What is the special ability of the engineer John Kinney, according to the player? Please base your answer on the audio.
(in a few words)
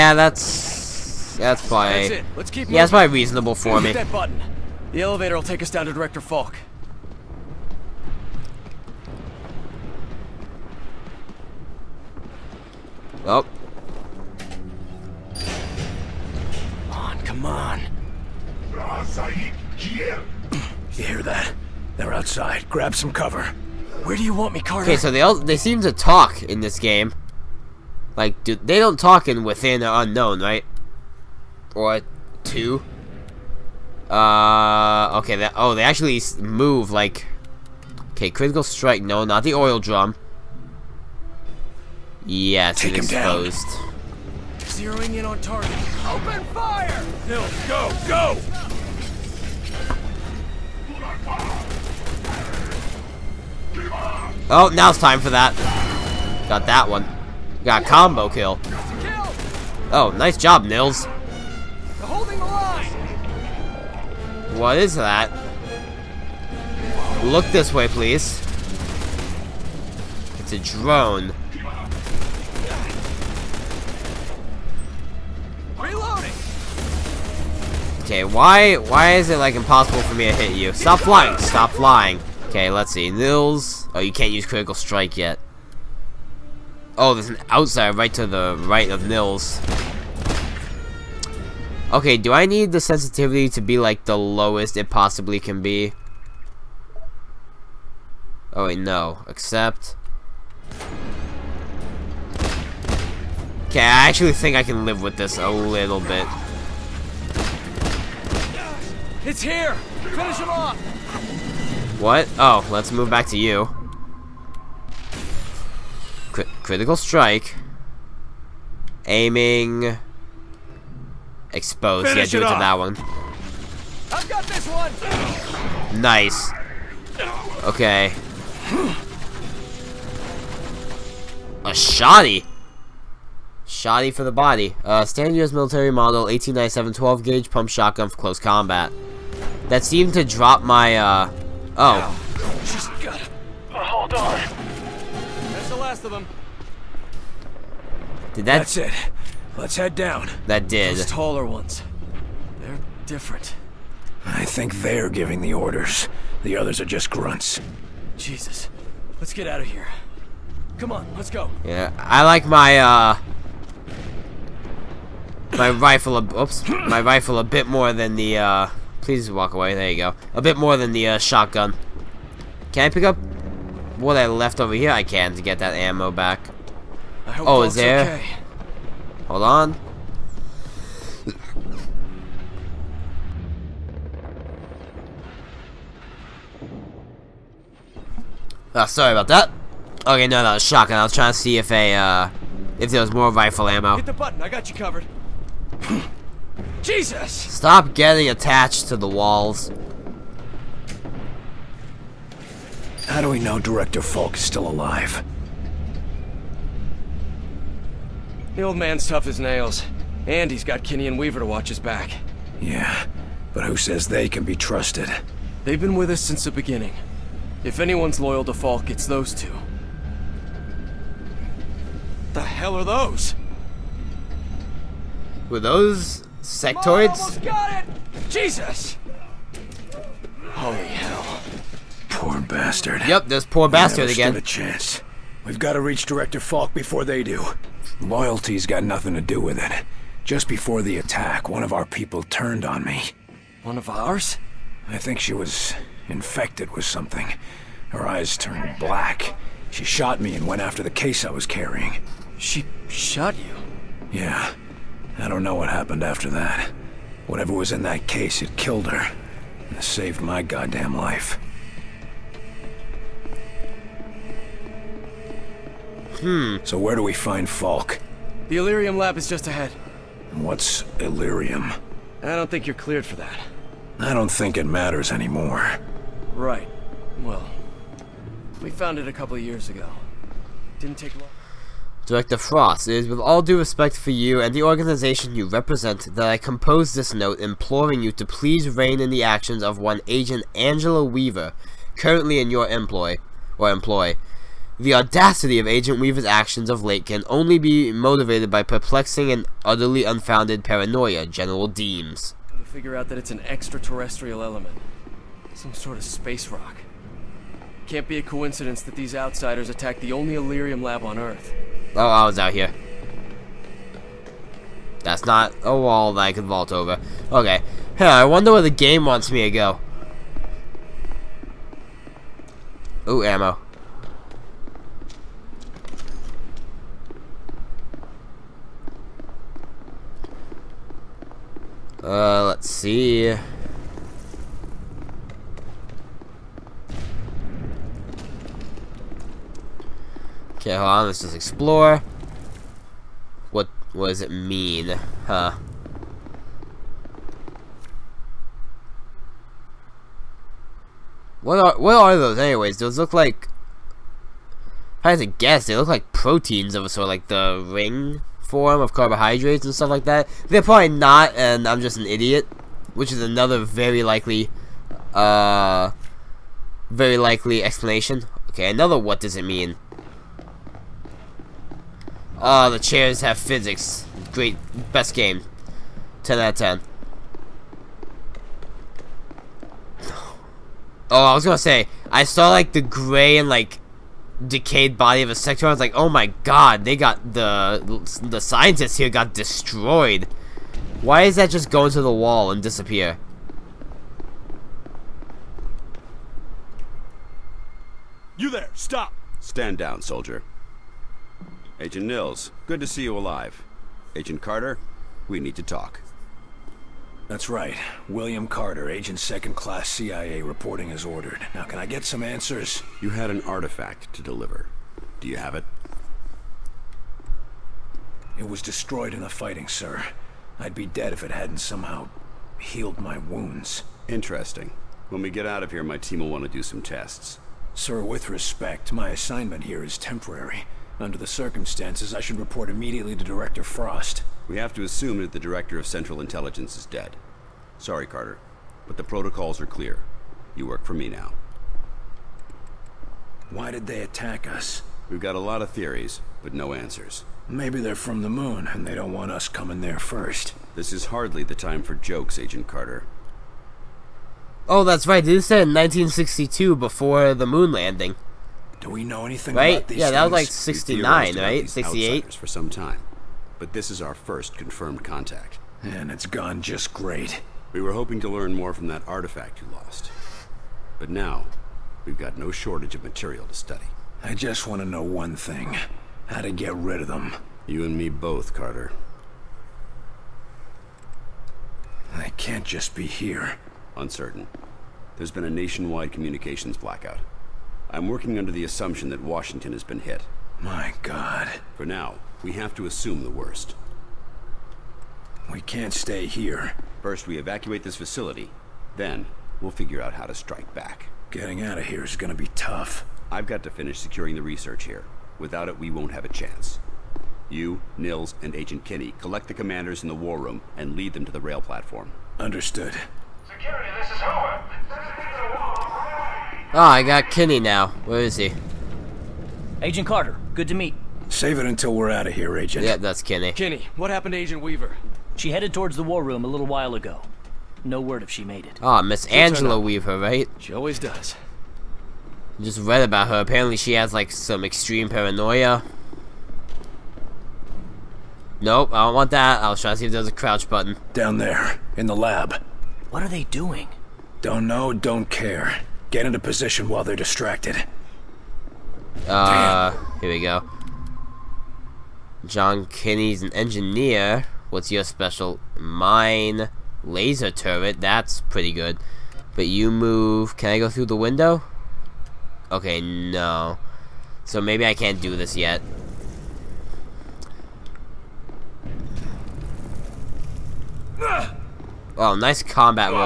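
laser turret.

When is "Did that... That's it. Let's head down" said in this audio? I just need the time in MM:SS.
02:28.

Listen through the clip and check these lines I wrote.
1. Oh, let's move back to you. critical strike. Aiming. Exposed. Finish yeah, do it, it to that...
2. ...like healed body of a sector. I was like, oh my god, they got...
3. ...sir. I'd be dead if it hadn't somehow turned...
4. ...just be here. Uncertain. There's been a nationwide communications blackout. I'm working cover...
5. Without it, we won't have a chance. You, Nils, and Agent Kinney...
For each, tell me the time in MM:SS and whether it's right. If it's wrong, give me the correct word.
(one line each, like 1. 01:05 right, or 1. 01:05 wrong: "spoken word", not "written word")
1. 01:52 right
2. 06:23 wrong: "decayed", not "healed"
3. 06:59 wrong: "healed", not "turned"
4. 08:02 wrong: "under", not "cover"
5. 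08:25 right.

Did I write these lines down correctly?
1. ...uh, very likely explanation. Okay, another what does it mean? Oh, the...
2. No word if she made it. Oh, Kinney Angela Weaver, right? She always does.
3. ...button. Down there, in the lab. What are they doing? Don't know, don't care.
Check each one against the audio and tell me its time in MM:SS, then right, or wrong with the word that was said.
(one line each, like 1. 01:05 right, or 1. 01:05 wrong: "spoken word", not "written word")
1. 06:05 right
2. 08:47 wrong: "Miss", not "Kinney"
3. 09:00 right.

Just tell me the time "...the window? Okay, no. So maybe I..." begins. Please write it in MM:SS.
09:21.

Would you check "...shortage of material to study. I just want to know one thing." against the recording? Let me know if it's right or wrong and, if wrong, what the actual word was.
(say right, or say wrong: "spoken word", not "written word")
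right.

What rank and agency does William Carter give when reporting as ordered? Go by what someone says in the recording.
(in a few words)
Agent Second Class CIA.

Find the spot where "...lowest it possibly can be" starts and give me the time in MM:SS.
01:34.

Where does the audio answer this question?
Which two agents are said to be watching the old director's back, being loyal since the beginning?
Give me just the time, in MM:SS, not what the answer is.
03:30.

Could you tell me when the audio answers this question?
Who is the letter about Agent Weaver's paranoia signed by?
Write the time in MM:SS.
05:01.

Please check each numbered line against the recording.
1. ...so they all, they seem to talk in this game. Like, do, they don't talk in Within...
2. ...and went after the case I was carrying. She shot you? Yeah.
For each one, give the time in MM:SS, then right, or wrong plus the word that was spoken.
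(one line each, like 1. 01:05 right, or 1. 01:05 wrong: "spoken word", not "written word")
1. 00:24 right
2. 04:10 right.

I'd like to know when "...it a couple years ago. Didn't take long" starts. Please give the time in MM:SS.
04:38.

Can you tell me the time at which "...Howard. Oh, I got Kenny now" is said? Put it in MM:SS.
08:34.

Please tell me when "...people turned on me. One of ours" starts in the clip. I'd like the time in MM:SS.
04:01.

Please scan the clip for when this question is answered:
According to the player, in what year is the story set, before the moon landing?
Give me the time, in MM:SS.
07:35.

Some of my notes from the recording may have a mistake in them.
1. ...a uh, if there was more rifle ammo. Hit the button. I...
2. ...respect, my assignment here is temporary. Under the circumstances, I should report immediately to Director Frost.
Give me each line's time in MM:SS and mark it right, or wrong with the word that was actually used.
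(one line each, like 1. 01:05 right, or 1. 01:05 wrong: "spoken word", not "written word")
1. 03:11 right
2. 07:08 right.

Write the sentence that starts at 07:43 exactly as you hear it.
But this is our first confirmed contact.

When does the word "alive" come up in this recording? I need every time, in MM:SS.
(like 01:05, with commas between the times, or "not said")
03:24, 06:43.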